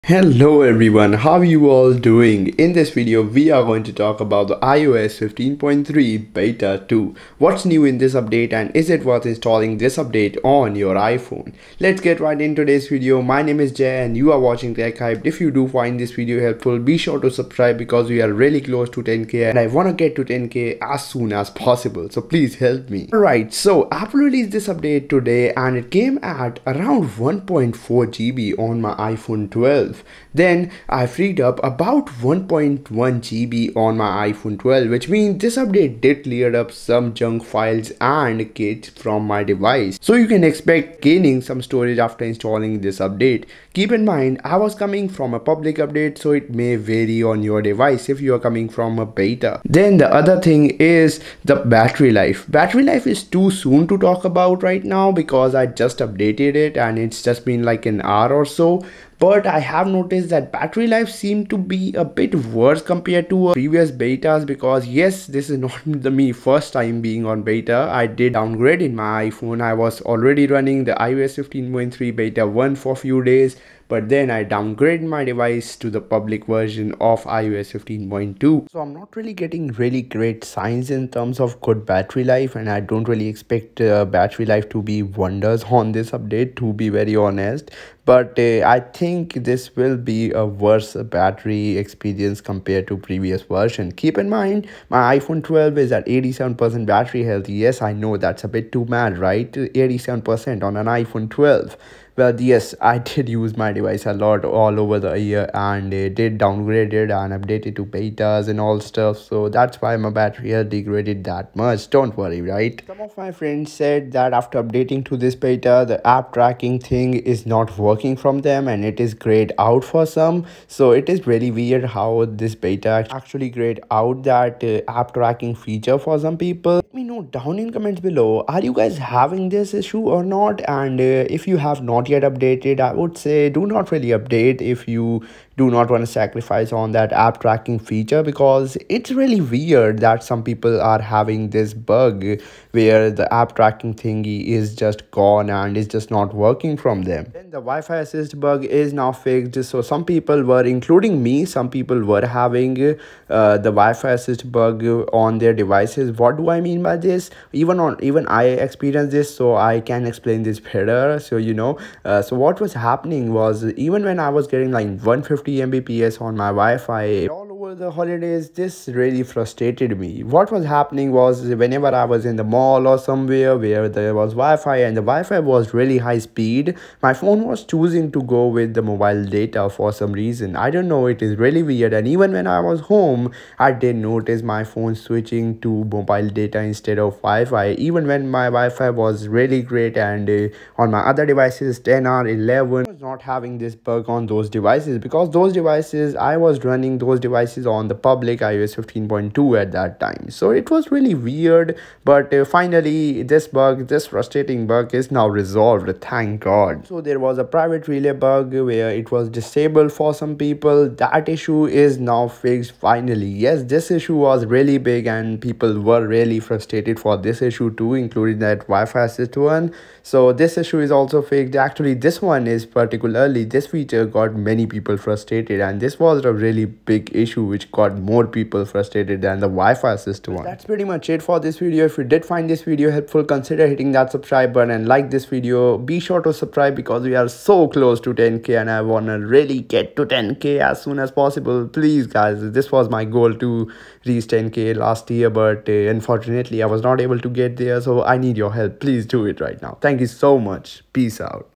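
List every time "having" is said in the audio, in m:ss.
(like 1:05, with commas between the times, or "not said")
2:08, 2:21, 2:32, 3:13.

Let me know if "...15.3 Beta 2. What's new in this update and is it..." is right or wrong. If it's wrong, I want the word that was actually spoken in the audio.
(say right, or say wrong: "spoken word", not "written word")
right.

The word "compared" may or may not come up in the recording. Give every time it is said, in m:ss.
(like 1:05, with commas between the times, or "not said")
1:02, 1:32.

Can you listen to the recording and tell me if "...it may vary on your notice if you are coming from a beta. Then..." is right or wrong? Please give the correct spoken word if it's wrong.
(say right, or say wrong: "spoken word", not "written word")
wrong: "device", not "notice".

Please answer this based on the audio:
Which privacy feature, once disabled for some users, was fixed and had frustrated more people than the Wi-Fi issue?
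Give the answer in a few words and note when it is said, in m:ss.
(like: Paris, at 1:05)
Private relay, at 3:27.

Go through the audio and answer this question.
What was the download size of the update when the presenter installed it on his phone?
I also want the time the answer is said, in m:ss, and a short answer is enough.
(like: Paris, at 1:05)
1.4 GB, at 0:27.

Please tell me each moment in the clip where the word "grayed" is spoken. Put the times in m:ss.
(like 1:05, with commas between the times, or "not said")
1:59, 2:03.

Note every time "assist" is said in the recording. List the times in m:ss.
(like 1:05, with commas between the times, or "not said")
2:27, 2:34, 3:39, 3:49.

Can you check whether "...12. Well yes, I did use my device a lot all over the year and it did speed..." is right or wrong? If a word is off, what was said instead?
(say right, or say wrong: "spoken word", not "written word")
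wrong: "downgraded", not "speed".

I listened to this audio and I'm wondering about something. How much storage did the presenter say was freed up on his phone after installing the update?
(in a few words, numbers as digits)
1.1 GB.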